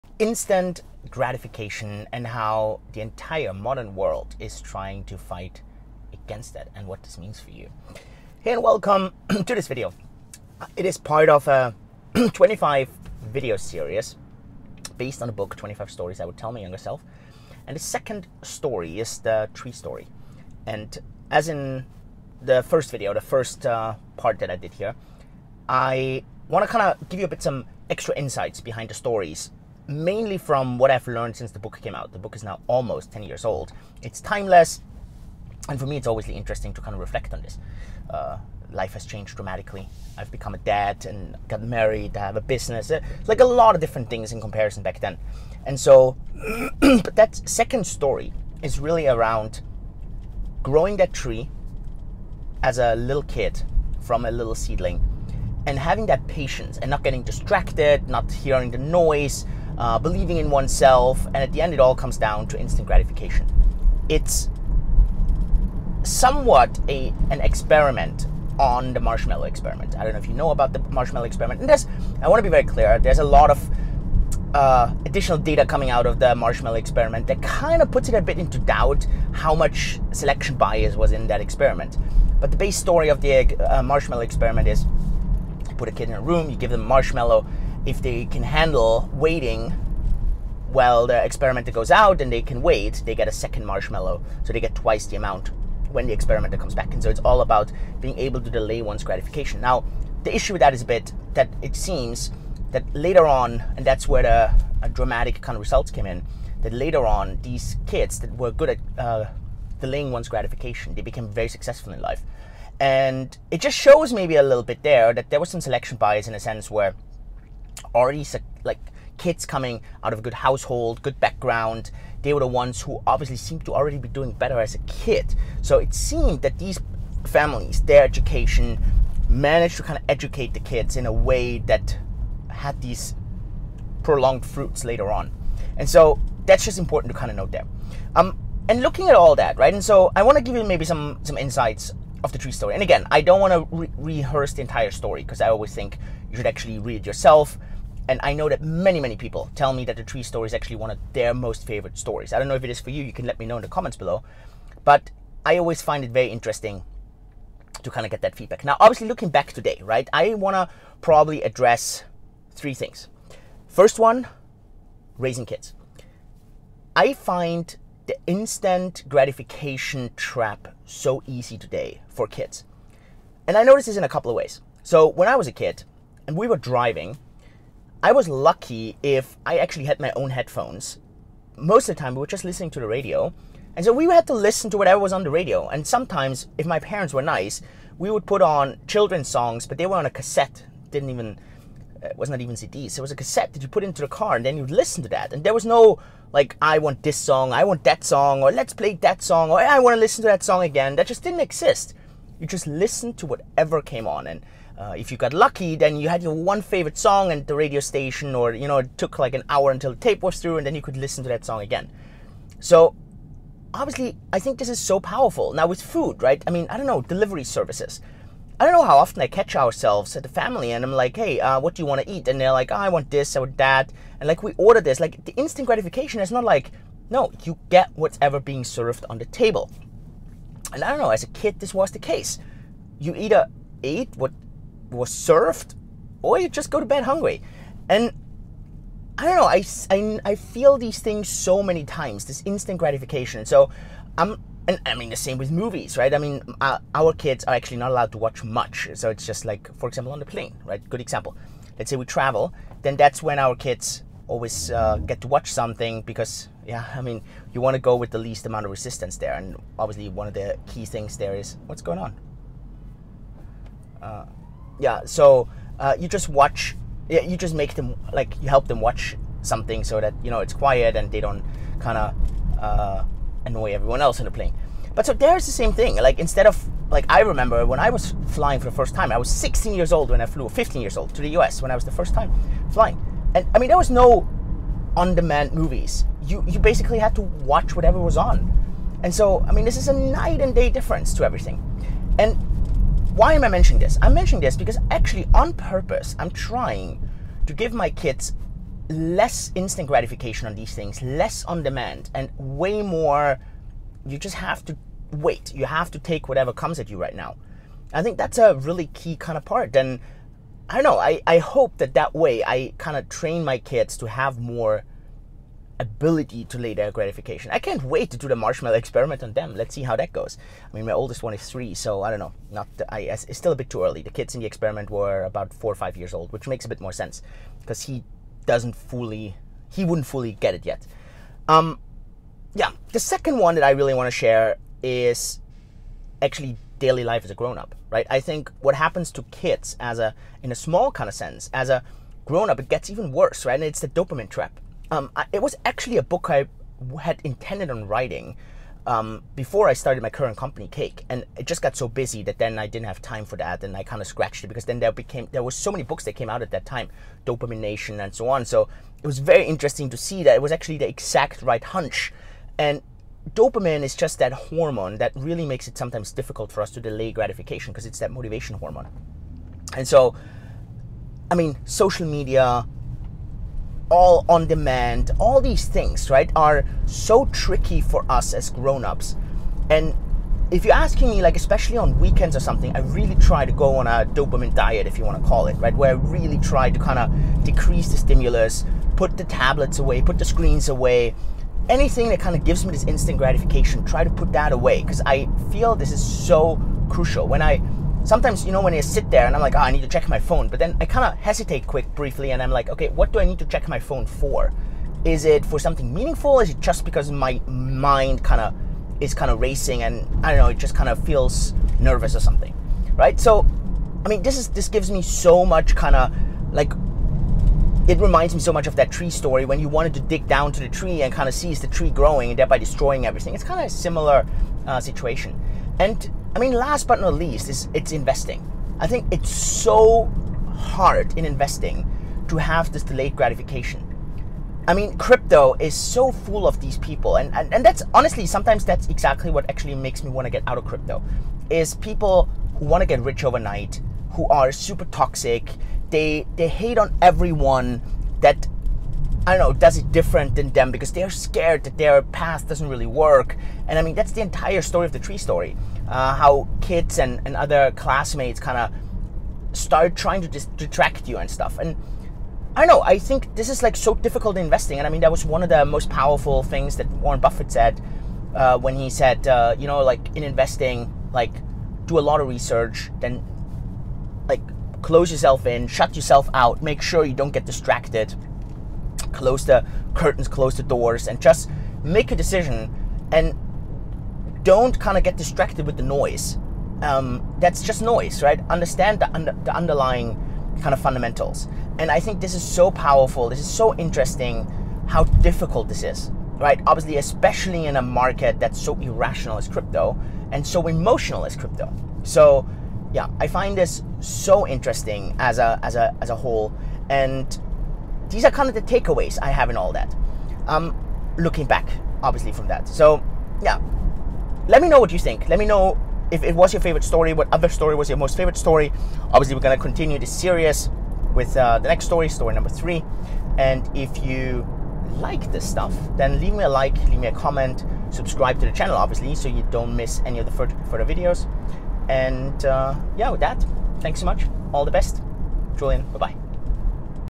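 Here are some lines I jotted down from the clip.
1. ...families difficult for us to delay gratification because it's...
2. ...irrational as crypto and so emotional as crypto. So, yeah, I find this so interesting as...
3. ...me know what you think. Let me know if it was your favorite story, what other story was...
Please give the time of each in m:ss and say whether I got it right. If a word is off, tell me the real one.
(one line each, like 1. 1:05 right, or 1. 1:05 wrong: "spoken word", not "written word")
1. 6:05 wrong: "sometimes", not "families"
2. 8:18 right
3. 8:34 right.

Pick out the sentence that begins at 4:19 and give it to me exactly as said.
And obviously, one of the key things there is what's going on.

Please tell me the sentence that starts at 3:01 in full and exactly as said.
Most of the time, we were just listening to the radio.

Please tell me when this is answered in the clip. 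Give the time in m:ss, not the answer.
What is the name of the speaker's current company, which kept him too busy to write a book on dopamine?
5:50.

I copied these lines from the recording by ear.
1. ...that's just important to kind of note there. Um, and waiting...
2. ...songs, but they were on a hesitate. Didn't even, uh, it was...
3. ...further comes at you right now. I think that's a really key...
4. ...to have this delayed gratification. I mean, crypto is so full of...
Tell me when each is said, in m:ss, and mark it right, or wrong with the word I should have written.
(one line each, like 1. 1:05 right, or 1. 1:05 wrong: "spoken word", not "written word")
1. 2:16 wrong: "looking", not "waiting"
2. 3:09 wrong: "cassette", not "hesitate"
3. 5:06 wrong: "whatever", not "further"
4. 7:12 right.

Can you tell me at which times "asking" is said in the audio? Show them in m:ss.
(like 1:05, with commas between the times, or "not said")
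6:20.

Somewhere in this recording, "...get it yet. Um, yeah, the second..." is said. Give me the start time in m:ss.
5:30.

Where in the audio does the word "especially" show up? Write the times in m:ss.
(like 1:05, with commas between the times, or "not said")
6:21, 8:16.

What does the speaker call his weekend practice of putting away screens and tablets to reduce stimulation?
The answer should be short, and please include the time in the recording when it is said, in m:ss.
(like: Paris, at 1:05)
dopamine diet, at 6:24.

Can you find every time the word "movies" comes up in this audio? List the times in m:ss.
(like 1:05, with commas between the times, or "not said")
4:05, 4:45.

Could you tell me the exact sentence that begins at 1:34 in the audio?
So they get twice the amount when the experimenter comes back.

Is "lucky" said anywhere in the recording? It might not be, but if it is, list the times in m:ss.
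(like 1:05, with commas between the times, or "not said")
2:58, 3:25.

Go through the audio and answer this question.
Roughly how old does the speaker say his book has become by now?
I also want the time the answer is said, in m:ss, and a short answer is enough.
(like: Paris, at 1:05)
almost 10 years, at 0:32.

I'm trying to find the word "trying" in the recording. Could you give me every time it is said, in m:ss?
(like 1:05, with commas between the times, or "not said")
0:04, 4:56, 7:39.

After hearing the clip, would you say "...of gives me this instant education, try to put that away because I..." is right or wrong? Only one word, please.
wrong.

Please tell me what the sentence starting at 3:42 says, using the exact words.
And they're like, oh, I want this, I want that.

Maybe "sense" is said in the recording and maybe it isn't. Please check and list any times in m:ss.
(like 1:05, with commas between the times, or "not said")
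1:56, 5:26, 5:41.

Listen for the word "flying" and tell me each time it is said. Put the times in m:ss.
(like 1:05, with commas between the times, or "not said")
4:38, 4:42.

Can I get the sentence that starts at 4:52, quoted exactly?
And why am I mentioning this?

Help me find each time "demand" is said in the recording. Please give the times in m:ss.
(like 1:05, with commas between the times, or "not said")
4:45, 5:01, 6:14.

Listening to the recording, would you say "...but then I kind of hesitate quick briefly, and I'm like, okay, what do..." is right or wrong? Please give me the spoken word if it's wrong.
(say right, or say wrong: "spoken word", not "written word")
right.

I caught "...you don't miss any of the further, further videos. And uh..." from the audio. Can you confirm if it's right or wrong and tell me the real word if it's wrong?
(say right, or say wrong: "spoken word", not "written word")
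right.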